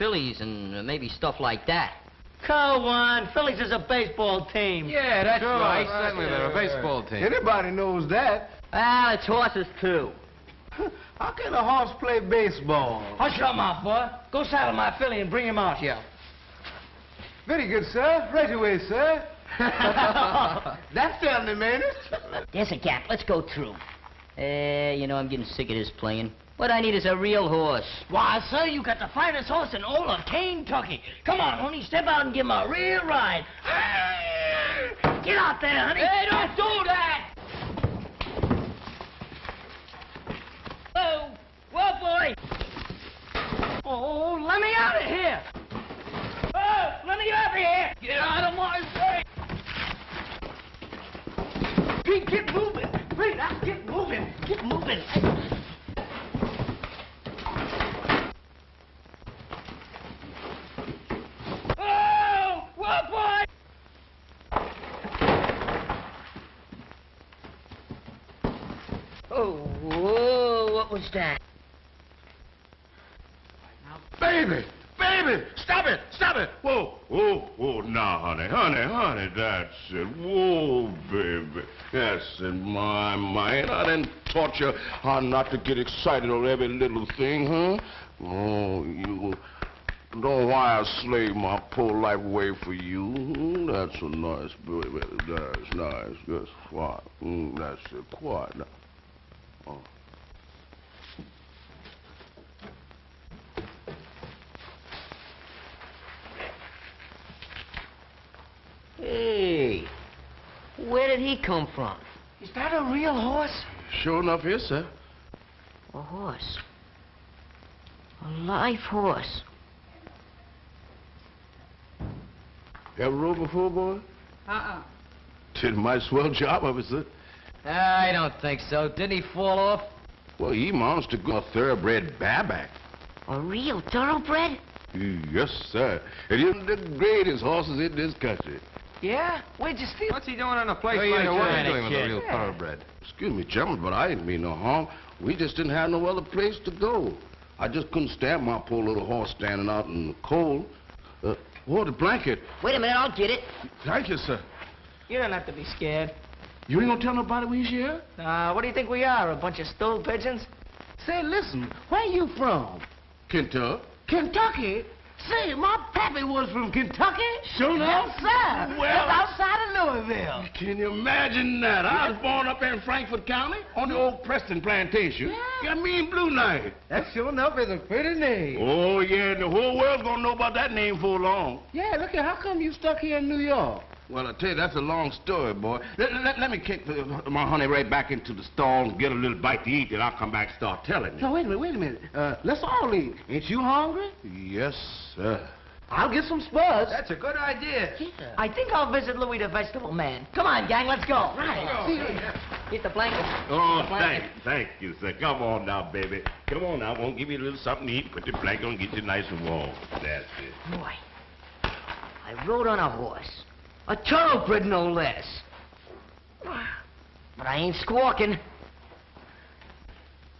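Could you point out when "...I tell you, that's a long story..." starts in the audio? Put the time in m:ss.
3:04.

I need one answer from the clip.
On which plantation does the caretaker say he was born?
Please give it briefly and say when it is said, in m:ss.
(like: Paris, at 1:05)
Preston plantation, at 2:54.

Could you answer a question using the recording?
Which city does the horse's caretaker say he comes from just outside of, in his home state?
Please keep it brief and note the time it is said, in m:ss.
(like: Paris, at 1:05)
Louisville, at 2:50.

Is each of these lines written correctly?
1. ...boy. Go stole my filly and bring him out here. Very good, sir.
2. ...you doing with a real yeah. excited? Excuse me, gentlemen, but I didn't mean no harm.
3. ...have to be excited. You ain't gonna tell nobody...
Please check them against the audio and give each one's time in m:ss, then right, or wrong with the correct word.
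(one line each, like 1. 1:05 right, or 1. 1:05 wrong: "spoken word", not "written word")
1. 0:13 wrong: "saddle", not "stole"
2. 2:21 wrong: "thoroughbred", not "excited"
3. 2:35 wrong: "scared", not "excited".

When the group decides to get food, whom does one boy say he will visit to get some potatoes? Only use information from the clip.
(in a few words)
Louis the vegetable man.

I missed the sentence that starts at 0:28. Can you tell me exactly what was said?
Why, sir, you got the finest horse in all of Kentucky.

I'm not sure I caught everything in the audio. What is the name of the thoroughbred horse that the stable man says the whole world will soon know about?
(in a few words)
Blue Knight.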